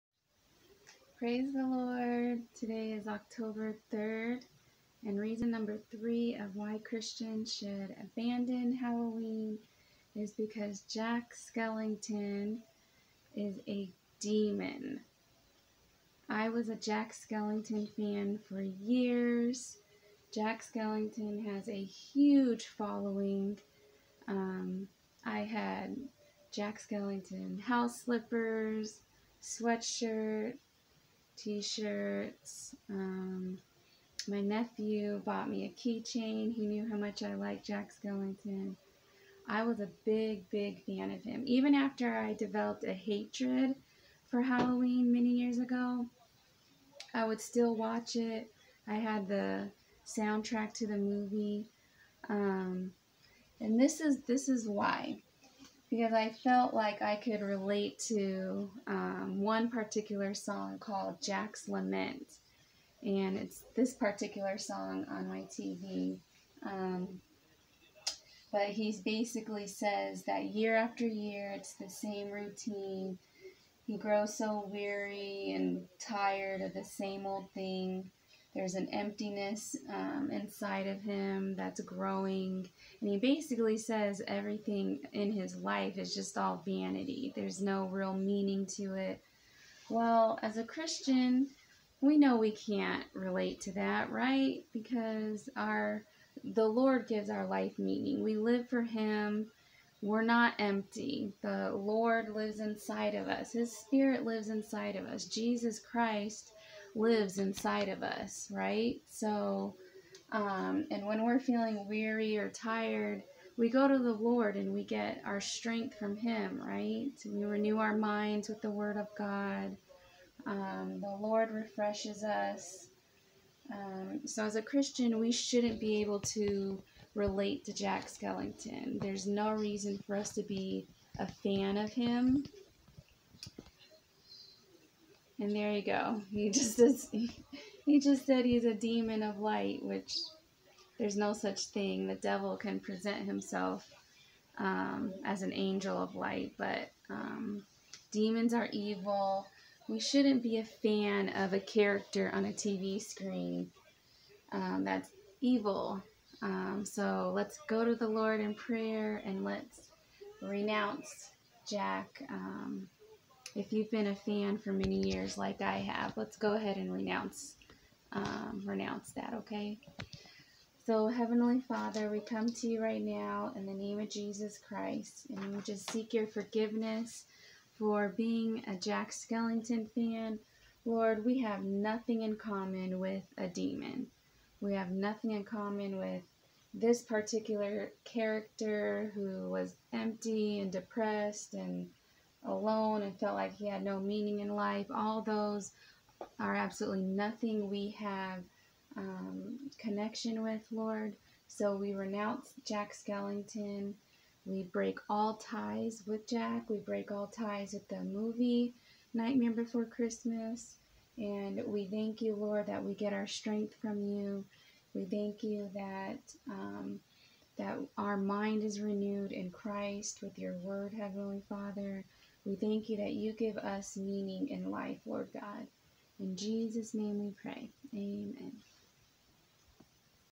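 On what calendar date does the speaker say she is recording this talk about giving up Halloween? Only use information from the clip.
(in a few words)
October 3rd.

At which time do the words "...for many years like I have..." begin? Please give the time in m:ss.
2:44.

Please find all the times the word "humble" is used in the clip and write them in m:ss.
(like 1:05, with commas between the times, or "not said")
not said.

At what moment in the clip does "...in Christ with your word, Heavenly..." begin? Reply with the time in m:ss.
3:39.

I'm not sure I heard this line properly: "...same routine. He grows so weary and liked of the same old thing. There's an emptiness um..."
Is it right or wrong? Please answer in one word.
wrong.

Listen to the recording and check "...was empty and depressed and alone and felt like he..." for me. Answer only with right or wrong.
right.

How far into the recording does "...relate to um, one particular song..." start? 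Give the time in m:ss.
0:57.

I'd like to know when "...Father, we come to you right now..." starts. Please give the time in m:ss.
2:51.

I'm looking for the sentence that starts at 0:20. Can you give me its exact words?
Jack Skellington has a huge following.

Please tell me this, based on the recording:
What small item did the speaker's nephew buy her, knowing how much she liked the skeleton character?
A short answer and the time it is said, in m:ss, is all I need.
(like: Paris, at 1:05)
A keychain, at 0:35.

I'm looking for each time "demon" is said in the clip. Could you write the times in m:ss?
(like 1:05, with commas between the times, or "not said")
0:14, 2:18, 2:28, 3:03.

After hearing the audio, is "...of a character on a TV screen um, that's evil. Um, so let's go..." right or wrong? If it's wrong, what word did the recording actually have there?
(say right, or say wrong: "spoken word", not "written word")
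right.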